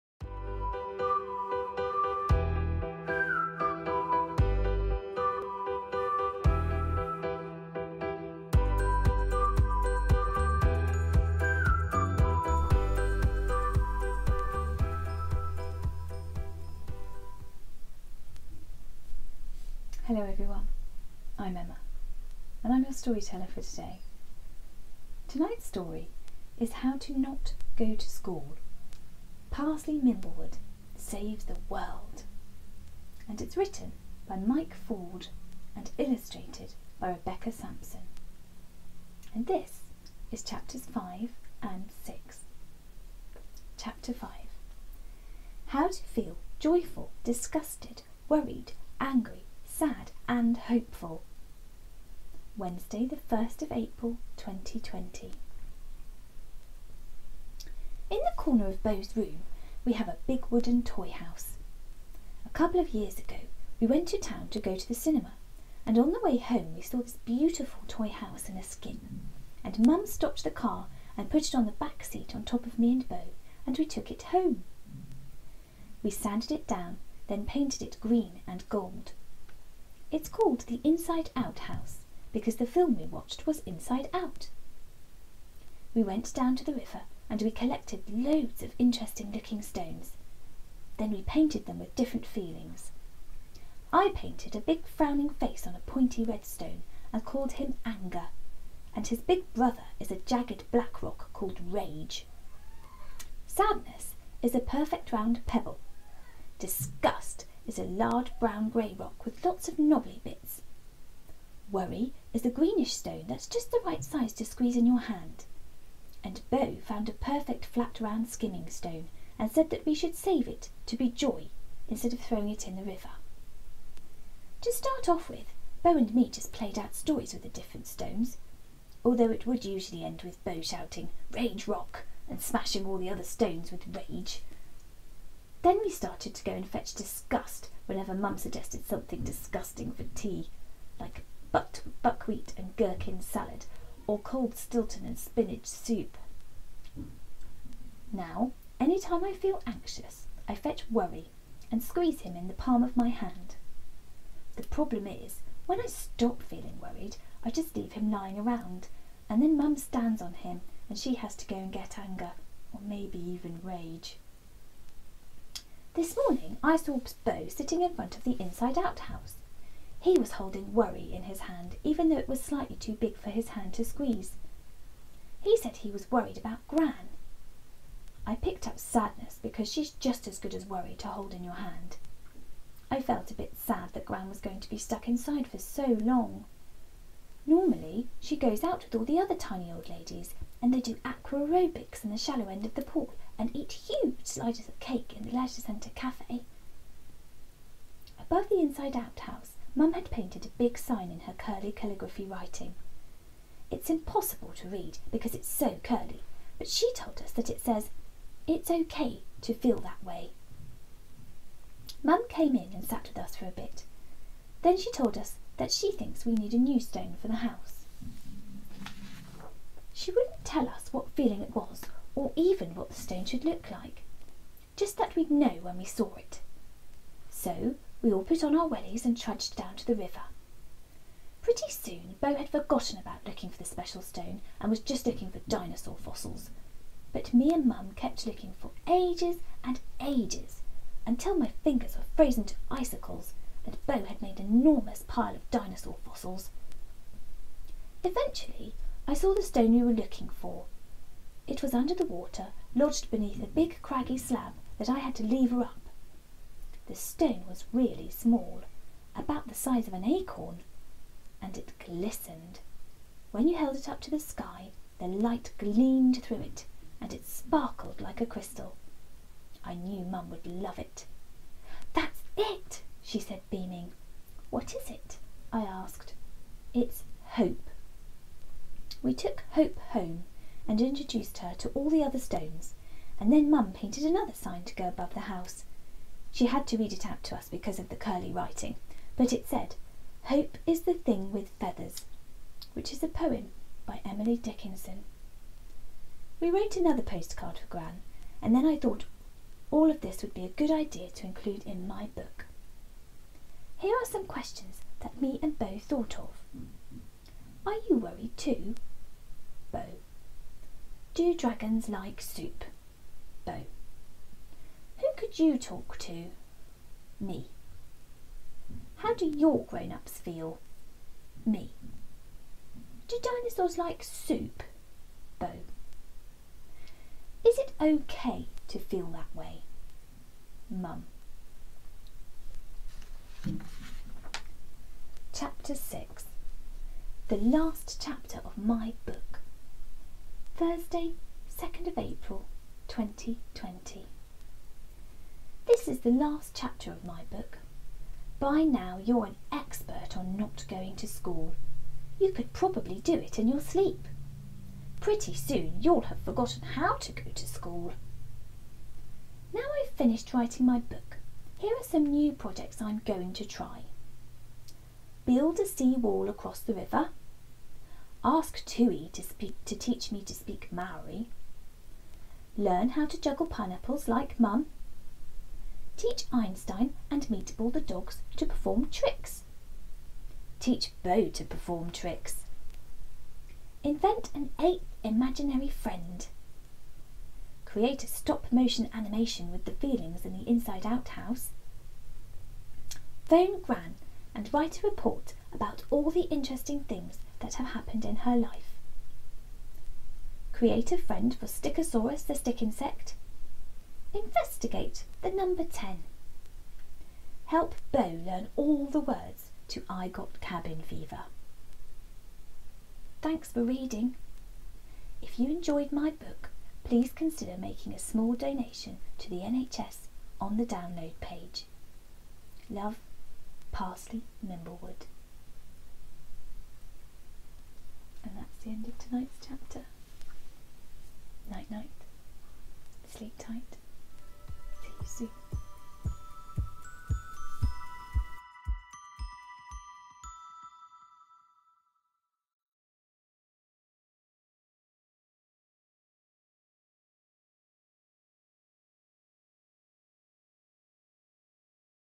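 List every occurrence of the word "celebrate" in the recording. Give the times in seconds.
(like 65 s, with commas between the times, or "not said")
not said.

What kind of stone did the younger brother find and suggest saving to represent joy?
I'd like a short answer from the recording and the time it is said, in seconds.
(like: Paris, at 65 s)
skimming stone, at 118 s.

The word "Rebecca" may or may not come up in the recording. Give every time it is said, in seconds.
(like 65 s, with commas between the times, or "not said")
37 s.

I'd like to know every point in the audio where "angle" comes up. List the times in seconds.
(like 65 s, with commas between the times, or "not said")
not said.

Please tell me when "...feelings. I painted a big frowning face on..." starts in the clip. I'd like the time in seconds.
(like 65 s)
92 s.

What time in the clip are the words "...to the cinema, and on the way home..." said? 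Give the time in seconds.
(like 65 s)
64 s.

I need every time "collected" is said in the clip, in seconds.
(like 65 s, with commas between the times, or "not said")
87 s.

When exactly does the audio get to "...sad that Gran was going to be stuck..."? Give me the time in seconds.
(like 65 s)
183 s.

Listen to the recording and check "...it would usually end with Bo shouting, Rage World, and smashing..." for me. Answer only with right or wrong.
wrong.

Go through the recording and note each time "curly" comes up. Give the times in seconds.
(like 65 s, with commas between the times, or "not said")
201 s, 205 s, 287 s.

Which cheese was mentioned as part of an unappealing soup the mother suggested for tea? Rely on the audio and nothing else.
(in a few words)
Stilton.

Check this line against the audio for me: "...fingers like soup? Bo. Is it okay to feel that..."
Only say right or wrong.
wrong.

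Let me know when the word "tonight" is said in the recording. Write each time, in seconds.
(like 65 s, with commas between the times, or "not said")
25 s, 428 s.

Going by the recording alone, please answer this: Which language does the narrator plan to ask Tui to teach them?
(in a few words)
Maori.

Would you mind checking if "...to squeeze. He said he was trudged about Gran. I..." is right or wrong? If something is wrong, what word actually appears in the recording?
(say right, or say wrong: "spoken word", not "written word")
wrong: "worried", not "trudged".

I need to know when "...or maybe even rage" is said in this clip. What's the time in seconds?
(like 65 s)
162 s.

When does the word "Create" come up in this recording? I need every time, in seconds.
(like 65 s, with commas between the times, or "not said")
387 s, 400 s.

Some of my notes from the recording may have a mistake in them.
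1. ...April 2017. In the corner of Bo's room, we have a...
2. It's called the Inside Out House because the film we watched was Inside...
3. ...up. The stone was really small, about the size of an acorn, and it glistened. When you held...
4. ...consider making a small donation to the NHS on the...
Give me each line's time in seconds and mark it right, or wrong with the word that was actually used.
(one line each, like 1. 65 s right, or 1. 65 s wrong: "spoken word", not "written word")
1. 53 s wrong: "2020", not "2017"
2. 80 s right
3. 255 s right
4. 417 s right.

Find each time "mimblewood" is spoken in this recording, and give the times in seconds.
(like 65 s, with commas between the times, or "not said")
30 s, 424 s.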